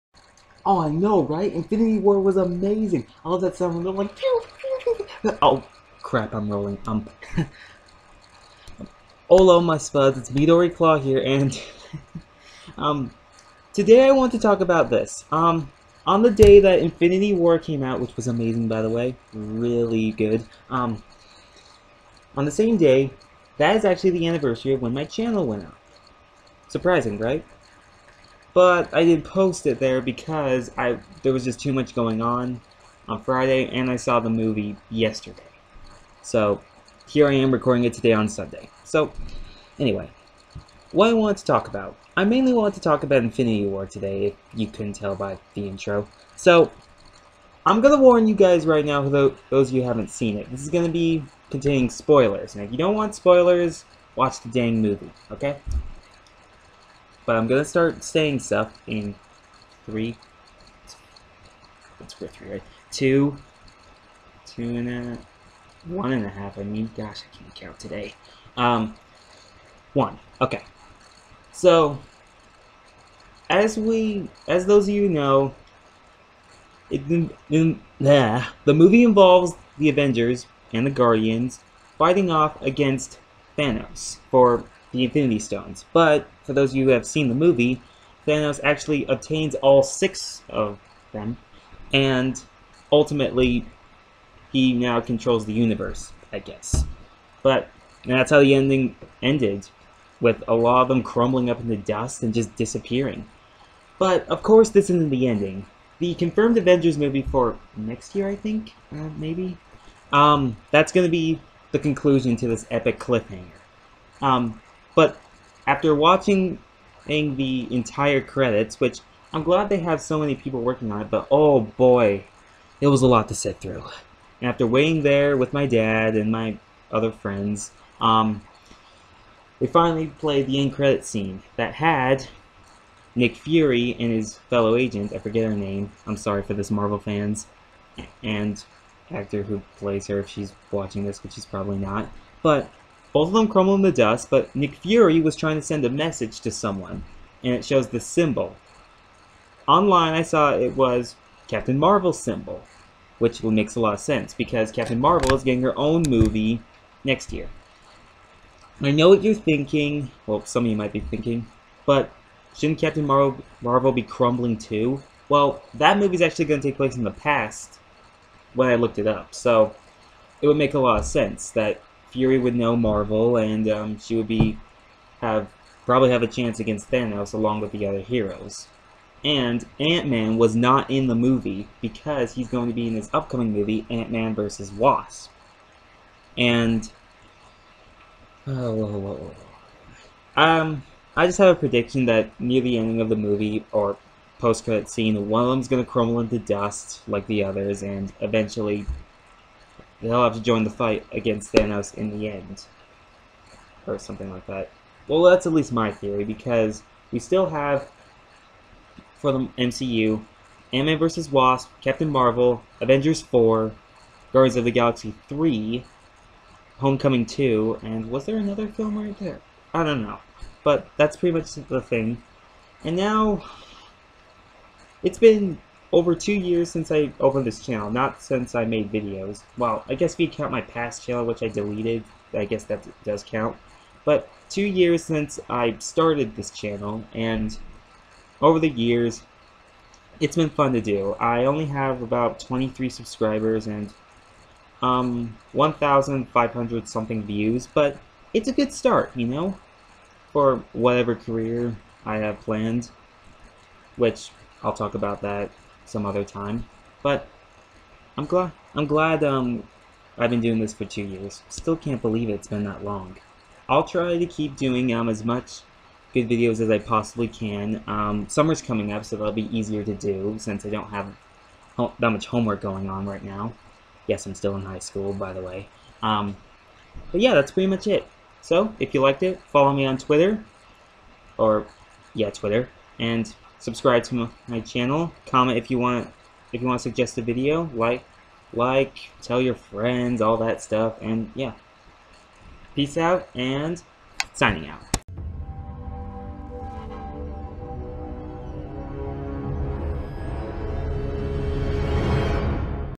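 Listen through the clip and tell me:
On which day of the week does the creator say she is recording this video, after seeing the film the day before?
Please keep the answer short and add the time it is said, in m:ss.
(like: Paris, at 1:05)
Sunday, at 0:38.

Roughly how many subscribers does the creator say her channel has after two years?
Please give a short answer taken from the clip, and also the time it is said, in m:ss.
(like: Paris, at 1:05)
23, at 4:02.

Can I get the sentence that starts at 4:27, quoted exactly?
Um, summer's coming up, so that'll be easier to do since I don't have that much homework going on right now.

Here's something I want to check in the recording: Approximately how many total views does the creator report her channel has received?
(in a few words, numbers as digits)
1,500.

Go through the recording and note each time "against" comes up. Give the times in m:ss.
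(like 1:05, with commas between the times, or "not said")
1:22, 2:56, 3:21.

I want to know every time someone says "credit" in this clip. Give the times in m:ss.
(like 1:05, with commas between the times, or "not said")
1:58, 2:10, 3:14.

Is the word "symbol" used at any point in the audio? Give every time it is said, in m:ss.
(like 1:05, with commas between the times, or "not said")
2:27, 2:32.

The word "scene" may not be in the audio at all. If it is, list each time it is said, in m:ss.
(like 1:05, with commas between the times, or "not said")
2:11, 3:14.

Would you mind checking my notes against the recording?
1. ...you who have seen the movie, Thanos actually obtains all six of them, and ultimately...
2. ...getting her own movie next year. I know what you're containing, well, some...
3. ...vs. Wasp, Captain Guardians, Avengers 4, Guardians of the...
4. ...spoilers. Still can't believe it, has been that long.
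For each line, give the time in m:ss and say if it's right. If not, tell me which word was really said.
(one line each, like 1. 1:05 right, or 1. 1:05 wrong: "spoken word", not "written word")
1. 1:26 right
2. 2:35 wrong: "thinking", not "containing"
3. 3:30 wrong: "Marvel", not "Guardians"
4. 4:21 wrong: "years", not "spoilers".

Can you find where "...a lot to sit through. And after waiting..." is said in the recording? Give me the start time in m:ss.
2:03.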